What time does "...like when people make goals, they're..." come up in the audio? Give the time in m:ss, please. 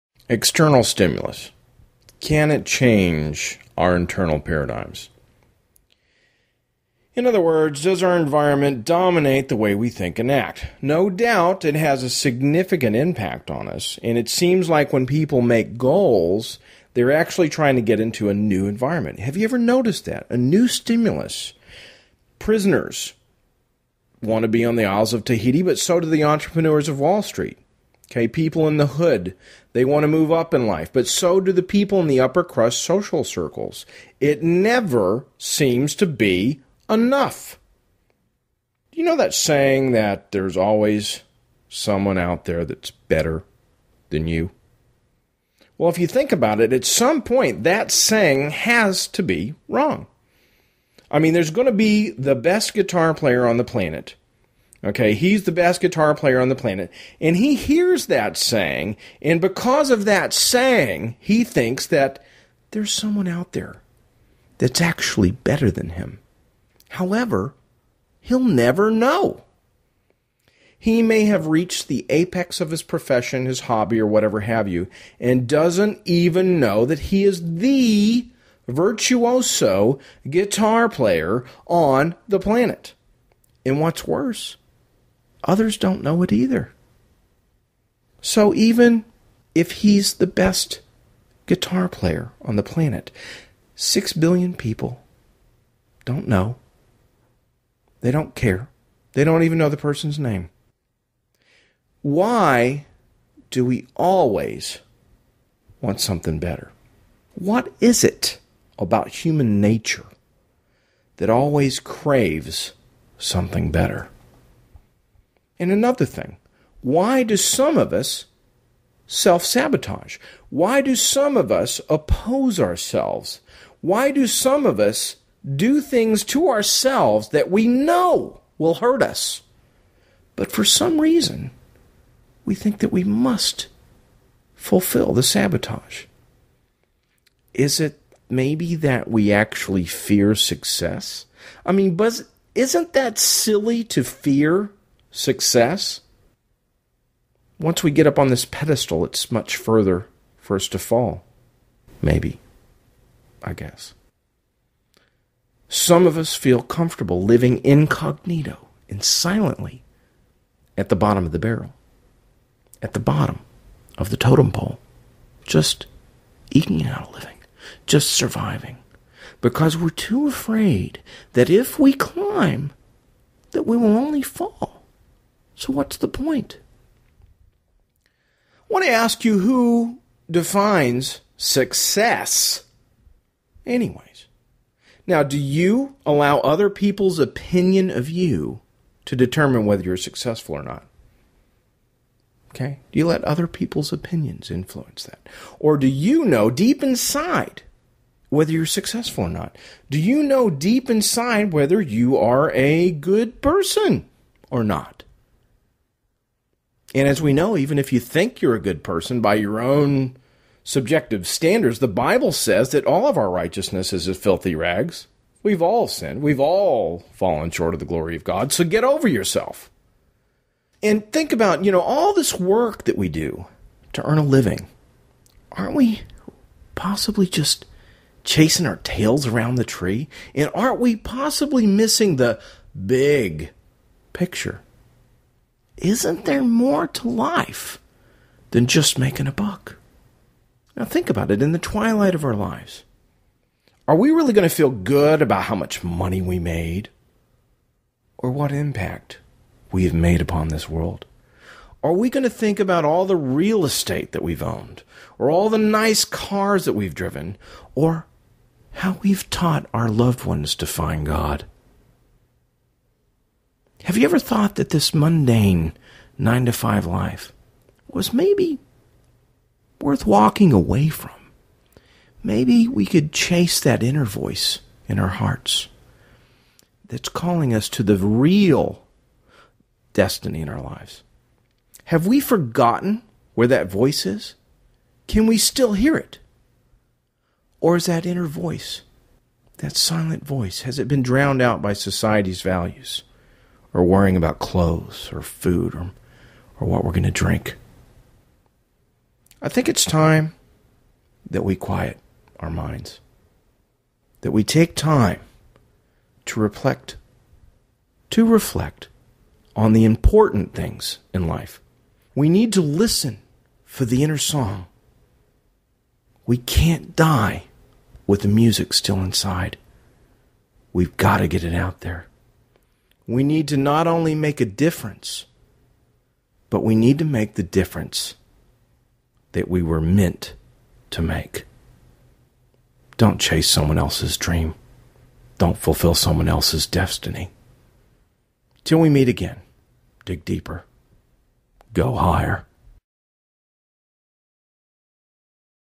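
0:14.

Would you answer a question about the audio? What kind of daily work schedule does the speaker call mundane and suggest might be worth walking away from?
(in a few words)
nine to five.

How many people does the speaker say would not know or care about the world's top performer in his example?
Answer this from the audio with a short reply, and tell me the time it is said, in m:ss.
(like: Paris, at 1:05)
6 billion, at 1:33.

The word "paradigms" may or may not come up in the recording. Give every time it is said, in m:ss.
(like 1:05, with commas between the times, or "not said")
0:04.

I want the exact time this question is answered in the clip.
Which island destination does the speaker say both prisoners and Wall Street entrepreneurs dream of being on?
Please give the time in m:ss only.
0:25.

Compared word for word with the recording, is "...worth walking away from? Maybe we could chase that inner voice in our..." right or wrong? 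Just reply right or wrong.
right.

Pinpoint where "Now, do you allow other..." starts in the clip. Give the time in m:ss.
3:05.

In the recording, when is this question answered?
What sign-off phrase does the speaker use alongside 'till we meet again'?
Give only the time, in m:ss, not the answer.
5:40.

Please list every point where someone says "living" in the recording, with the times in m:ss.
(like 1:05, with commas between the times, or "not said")
2:37, 2:47, 3:44.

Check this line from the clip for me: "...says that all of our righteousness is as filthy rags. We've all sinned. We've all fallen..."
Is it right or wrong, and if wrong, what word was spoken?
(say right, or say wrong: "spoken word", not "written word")
right.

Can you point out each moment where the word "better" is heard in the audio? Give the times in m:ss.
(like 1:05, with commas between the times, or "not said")
0:42, 1:05, 1:46, 1:53.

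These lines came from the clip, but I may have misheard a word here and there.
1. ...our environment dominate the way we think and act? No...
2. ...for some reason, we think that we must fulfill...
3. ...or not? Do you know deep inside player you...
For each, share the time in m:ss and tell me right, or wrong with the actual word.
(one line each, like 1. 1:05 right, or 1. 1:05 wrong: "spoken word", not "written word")
1. 0:08 right
2. 2:10 right
3. 3:19 wrong: "whether", not "player".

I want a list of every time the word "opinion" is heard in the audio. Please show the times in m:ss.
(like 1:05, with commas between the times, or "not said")
3:07, 3:13.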